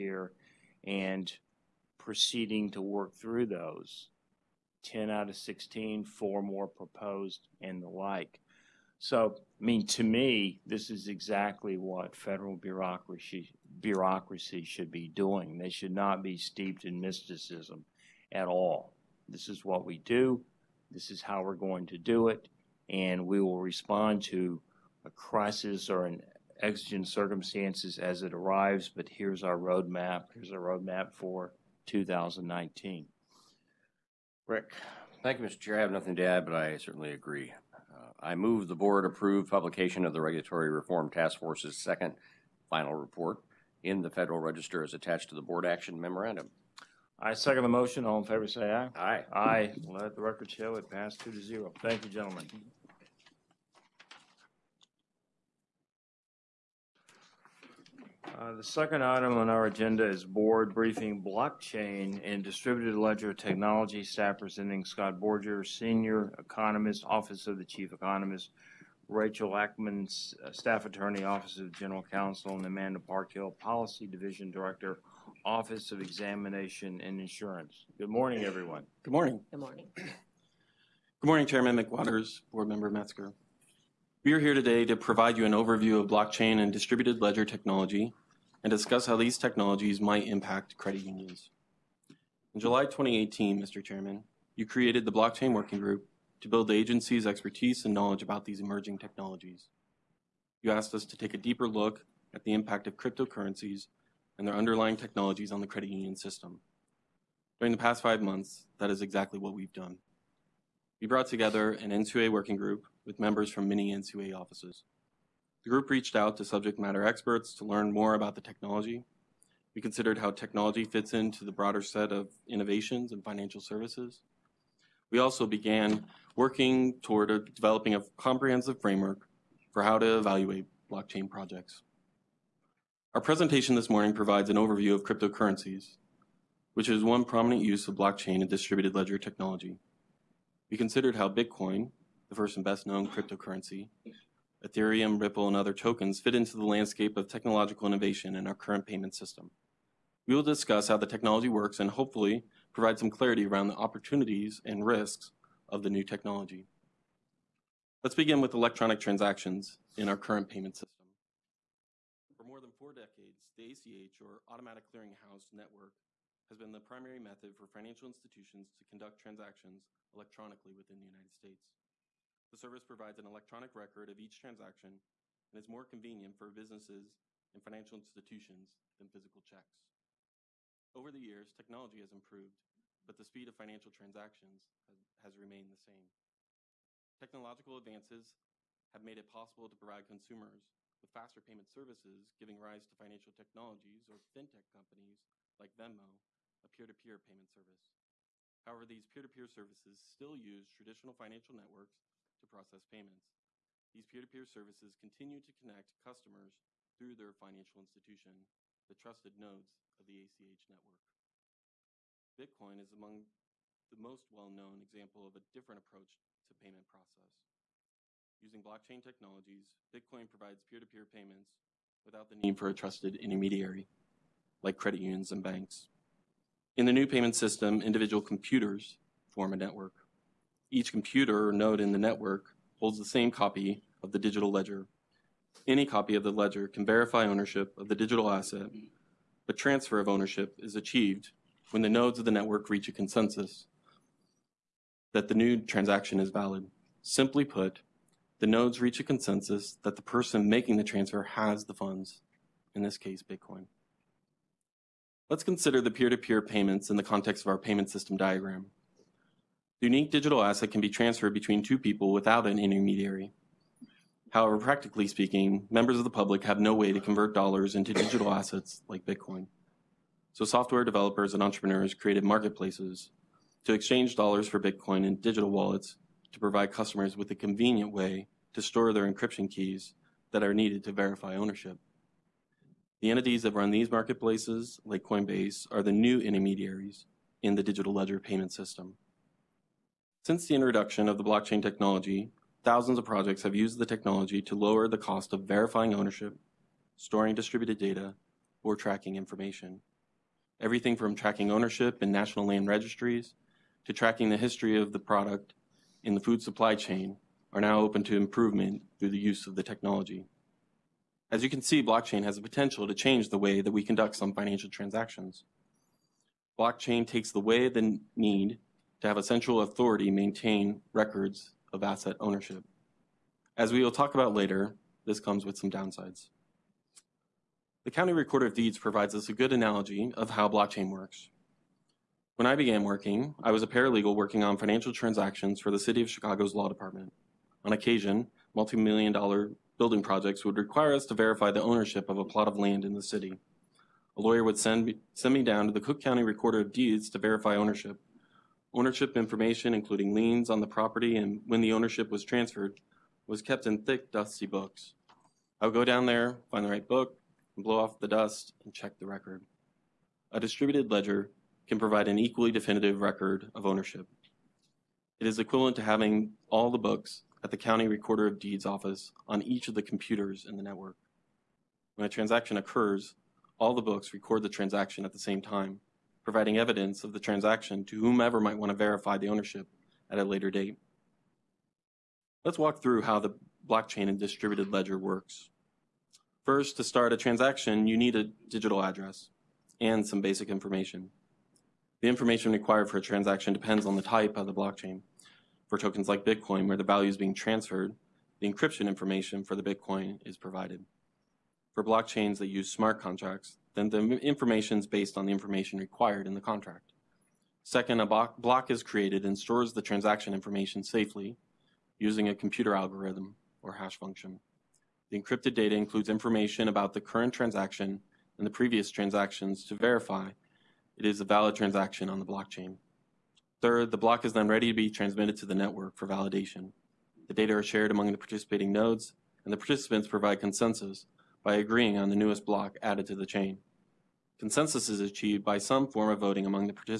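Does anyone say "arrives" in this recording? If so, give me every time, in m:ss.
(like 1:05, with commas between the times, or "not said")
0:28.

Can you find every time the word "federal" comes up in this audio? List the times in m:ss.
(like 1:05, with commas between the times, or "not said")
0:12, 0:44.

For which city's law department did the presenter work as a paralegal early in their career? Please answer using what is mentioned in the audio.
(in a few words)
Chicago.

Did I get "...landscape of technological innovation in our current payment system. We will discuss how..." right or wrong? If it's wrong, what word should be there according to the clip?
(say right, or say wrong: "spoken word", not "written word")
right.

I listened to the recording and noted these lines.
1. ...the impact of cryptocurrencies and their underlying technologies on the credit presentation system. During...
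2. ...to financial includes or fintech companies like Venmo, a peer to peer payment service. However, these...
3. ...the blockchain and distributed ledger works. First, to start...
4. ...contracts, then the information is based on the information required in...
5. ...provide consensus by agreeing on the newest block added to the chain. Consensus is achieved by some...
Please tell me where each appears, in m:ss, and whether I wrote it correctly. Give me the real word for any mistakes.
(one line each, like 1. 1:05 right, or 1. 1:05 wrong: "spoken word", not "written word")
1. 1:42 wrong: "union", not "presentation"
2. 3:12 wrong: "technologies", not "includes"
3. 6:23 right
4. 6:43 right
5. 7:10 right.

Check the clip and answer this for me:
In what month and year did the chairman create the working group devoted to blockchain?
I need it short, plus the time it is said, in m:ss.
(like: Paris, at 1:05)
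July 2018, at 1:32.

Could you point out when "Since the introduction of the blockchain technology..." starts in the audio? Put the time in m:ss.
4:50.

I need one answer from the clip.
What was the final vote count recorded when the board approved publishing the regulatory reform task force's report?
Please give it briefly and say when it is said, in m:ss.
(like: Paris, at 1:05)
2 to 0, at 0:51.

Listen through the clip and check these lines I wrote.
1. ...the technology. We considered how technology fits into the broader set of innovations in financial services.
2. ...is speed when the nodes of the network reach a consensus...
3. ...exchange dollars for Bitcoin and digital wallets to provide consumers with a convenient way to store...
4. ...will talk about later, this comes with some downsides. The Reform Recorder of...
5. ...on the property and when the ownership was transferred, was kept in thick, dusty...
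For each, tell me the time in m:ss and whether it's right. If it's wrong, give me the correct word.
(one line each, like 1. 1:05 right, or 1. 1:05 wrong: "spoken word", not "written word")
1. 1:58 right
2. 4:00 wrong: "achieved", not "speed"
3. 4:33 wrong: "customers", not "consumers"
4. 5:23 wrong: "County", not "Reform"
5. 5:50 right.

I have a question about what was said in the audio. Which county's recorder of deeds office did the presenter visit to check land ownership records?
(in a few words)
Cook County.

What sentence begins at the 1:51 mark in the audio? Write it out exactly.
We brought together an NCUA working group with members from many NCUA offices.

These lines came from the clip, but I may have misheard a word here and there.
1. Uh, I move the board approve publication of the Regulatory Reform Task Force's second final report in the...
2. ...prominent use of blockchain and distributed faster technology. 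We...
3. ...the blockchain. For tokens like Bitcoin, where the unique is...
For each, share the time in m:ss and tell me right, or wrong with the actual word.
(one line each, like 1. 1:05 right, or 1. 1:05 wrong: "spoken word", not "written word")
1. 0:37 right
2. 2:17 wrong: "ledger", not "faster"
3. 6:34 wrong: "value", not "unique".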